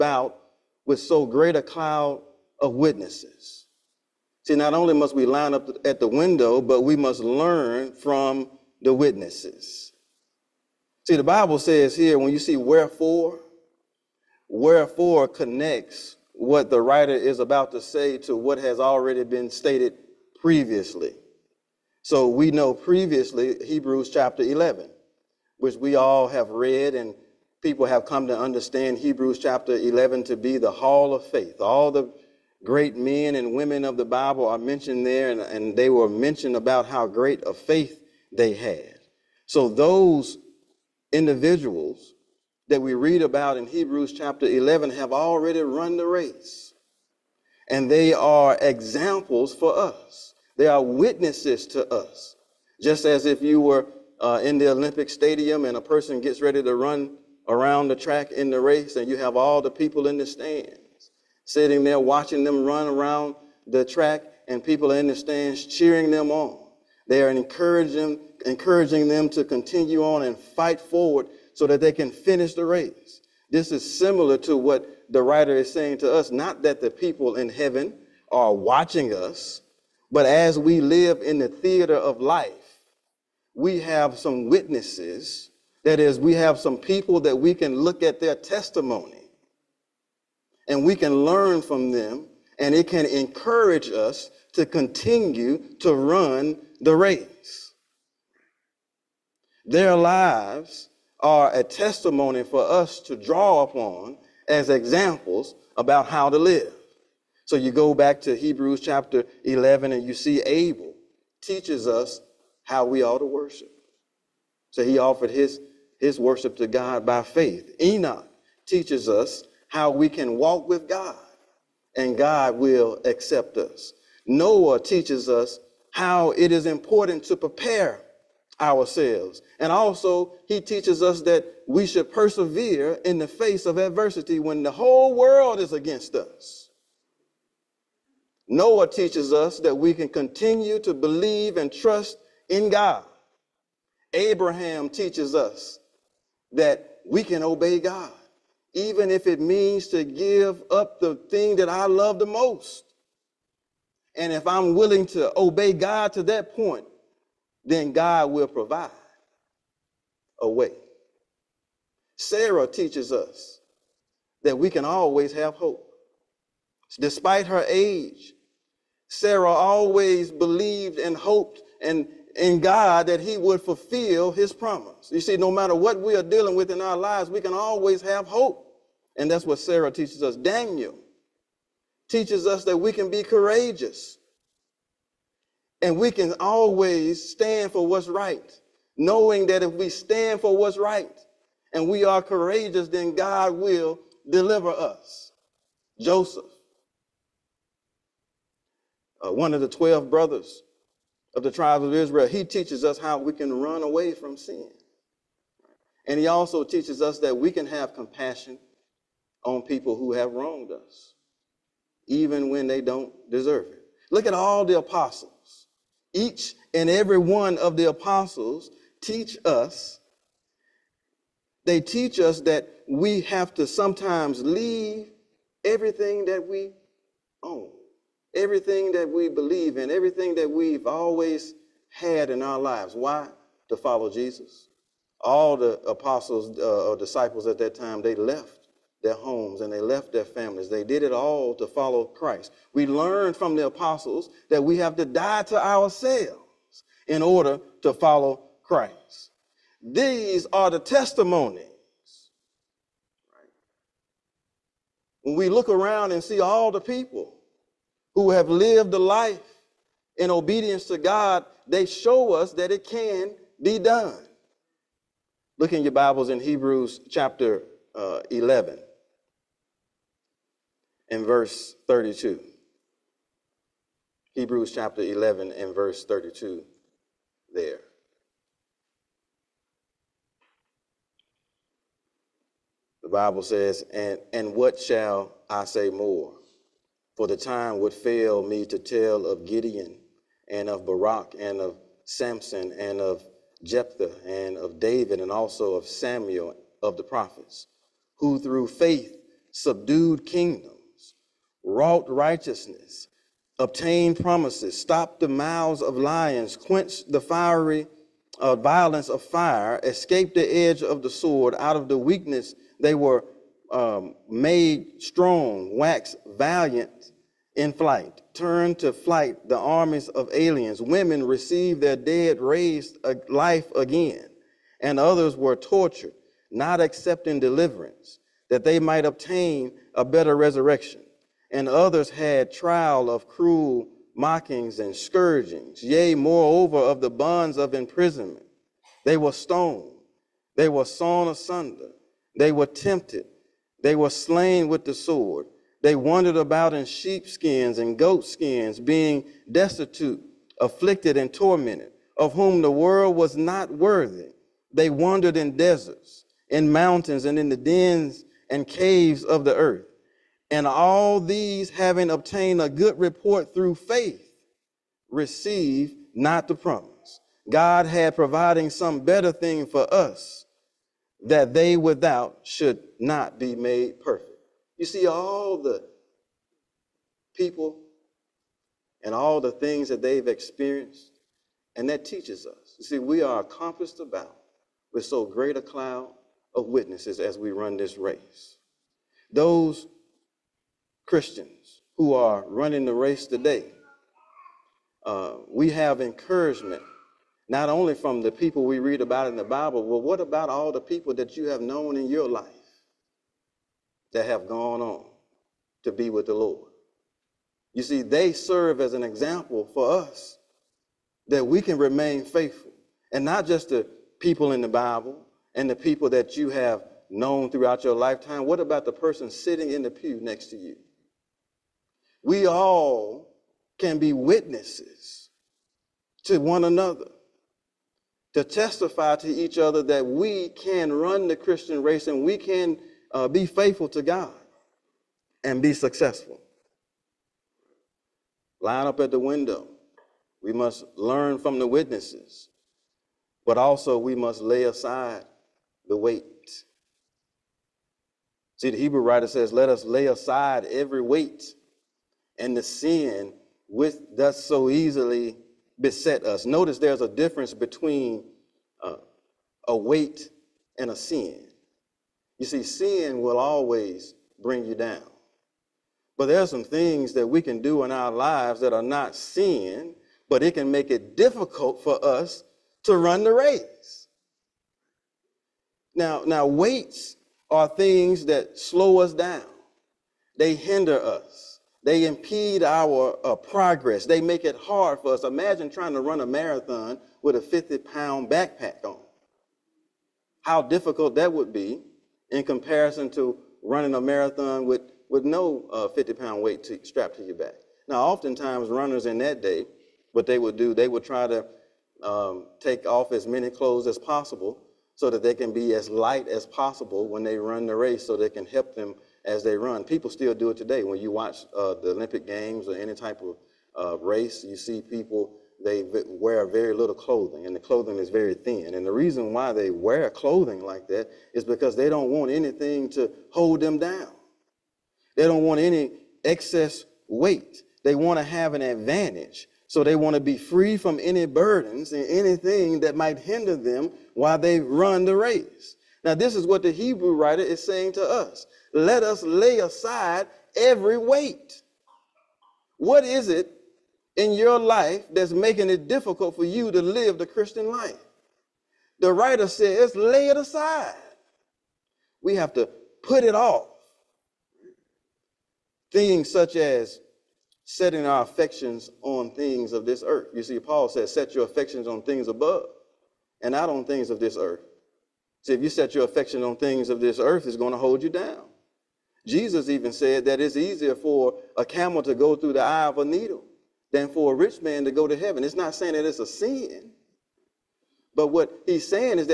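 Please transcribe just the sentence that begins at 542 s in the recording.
What is it in your life that's making it difficult for you to live the Christian life?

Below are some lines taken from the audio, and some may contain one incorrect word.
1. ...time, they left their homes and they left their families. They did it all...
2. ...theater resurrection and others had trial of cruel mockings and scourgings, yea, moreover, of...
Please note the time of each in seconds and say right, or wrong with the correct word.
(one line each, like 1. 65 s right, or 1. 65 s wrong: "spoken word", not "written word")
1. 237 s right
2. 330 s wrong: "better", not "theater".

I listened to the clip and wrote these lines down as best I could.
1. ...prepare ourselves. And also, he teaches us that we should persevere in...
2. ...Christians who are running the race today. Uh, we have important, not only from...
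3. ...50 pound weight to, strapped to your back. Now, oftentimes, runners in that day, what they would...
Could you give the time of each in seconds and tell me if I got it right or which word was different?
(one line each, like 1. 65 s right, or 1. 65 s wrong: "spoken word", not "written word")
1. 127 s right
2. 391 s wrong: "encouragement", not "important"
3. 495 s right.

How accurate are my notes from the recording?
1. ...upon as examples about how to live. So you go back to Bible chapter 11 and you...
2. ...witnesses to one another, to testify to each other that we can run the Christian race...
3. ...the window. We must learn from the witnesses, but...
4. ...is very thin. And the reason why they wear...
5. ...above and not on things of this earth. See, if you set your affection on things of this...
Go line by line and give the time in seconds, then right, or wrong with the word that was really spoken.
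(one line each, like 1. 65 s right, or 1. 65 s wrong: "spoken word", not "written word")
1. 103 s wrong: "Hebrews", not "Bible"
2. 424 s right
3. 439 s right
4. 517 s right
5. 562 s right.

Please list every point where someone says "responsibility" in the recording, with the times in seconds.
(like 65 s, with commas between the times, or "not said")
not said.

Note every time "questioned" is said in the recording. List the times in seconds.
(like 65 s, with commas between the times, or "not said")
not said.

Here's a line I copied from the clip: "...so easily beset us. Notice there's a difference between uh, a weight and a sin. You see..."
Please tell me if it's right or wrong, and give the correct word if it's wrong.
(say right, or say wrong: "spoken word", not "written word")
right.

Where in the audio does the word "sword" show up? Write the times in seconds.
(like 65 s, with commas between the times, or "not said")
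311 s, 344 s.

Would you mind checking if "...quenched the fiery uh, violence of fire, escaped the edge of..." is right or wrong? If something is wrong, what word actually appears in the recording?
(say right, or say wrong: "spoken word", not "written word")
right.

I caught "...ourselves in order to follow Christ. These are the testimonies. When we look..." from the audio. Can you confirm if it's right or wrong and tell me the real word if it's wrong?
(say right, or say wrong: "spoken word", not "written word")
right.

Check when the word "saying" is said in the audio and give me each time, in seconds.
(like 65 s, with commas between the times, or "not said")
75 s, 537 s, 575 s.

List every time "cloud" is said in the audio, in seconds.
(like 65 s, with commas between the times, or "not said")
1 s, 385 s.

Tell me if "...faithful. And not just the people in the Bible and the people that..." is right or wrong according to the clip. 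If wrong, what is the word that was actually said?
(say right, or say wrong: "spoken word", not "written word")
right.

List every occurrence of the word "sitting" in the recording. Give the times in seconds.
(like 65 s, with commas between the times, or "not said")
61 s, 419 s.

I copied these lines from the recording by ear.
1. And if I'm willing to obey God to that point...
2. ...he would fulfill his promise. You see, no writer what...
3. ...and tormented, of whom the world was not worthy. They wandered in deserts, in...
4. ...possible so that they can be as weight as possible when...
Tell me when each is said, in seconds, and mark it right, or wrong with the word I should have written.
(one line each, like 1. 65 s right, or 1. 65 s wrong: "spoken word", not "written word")
1. 154 s right
2. 173 s wrong: "matter", not "writer"
3. 351 s right
4. 503 s wrong: "light", not "weight".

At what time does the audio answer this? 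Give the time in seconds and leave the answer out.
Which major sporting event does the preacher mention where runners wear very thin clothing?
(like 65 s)
511 s.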